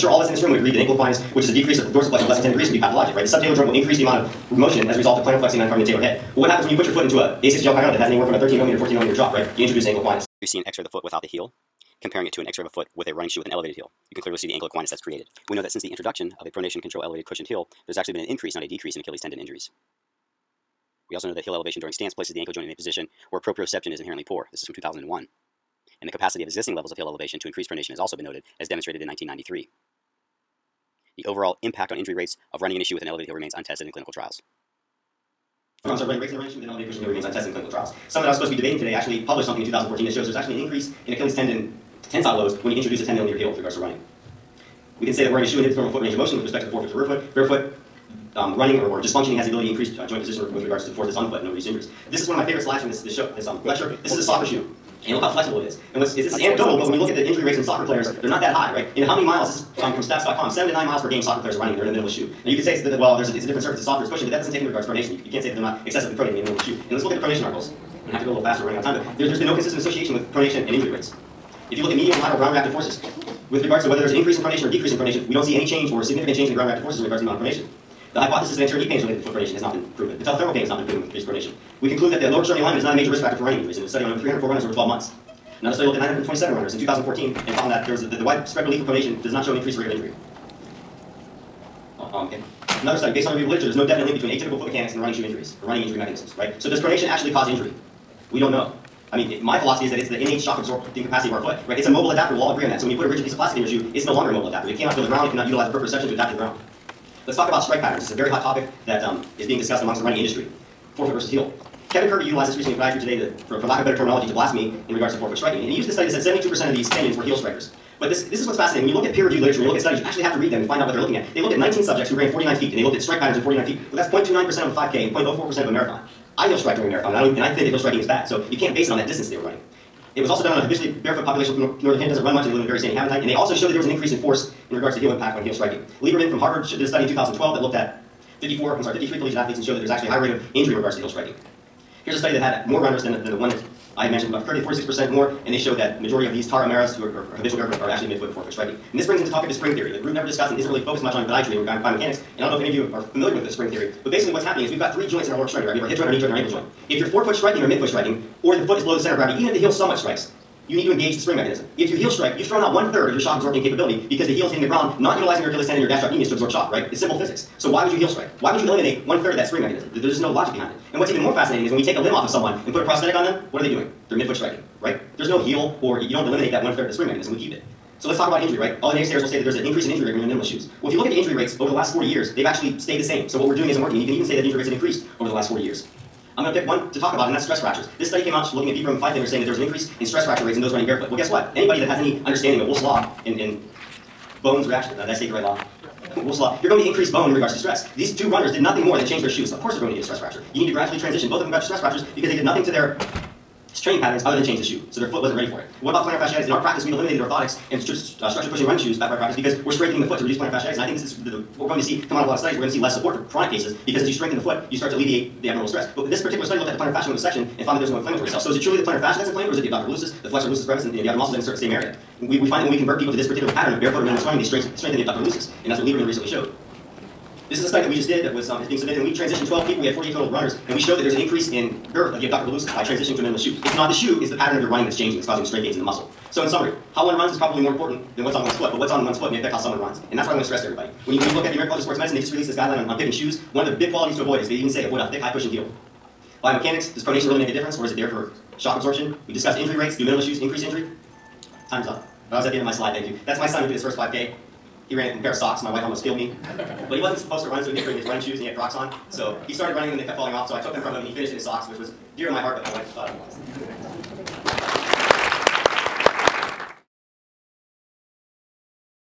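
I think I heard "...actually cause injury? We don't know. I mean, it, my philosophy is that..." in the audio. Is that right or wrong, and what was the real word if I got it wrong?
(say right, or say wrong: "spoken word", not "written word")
right.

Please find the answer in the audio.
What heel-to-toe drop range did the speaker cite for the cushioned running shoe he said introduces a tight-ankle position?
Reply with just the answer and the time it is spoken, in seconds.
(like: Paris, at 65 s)
13 to 14 millimeters, at 8 s.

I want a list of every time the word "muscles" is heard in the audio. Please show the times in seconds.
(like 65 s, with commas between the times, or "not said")
221 s, 235 s.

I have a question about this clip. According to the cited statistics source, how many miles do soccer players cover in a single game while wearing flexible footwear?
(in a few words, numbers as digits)
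7 to 9 miles.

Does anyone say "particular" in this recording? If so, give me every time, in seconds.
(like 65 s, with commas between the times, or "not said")
216 s, 223 s.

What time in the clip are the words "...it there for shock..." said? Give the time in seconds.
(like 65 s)
247 s.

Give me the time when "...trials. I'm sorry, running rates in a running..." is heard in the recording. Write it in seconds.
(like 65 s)
34 s.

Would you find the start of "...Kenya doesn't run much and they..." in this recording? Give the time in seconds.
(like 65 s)
131 s.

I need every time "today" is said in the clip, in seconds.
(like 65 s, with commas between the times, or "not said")
38 s, 113 s.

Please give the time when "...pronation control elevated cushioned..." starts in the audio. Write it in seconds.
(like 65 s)
16 s.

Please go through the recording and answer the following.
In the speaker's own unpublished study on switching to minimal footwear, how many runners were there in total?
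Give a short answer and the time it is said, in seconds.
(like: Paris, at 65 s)
48, at 229 s.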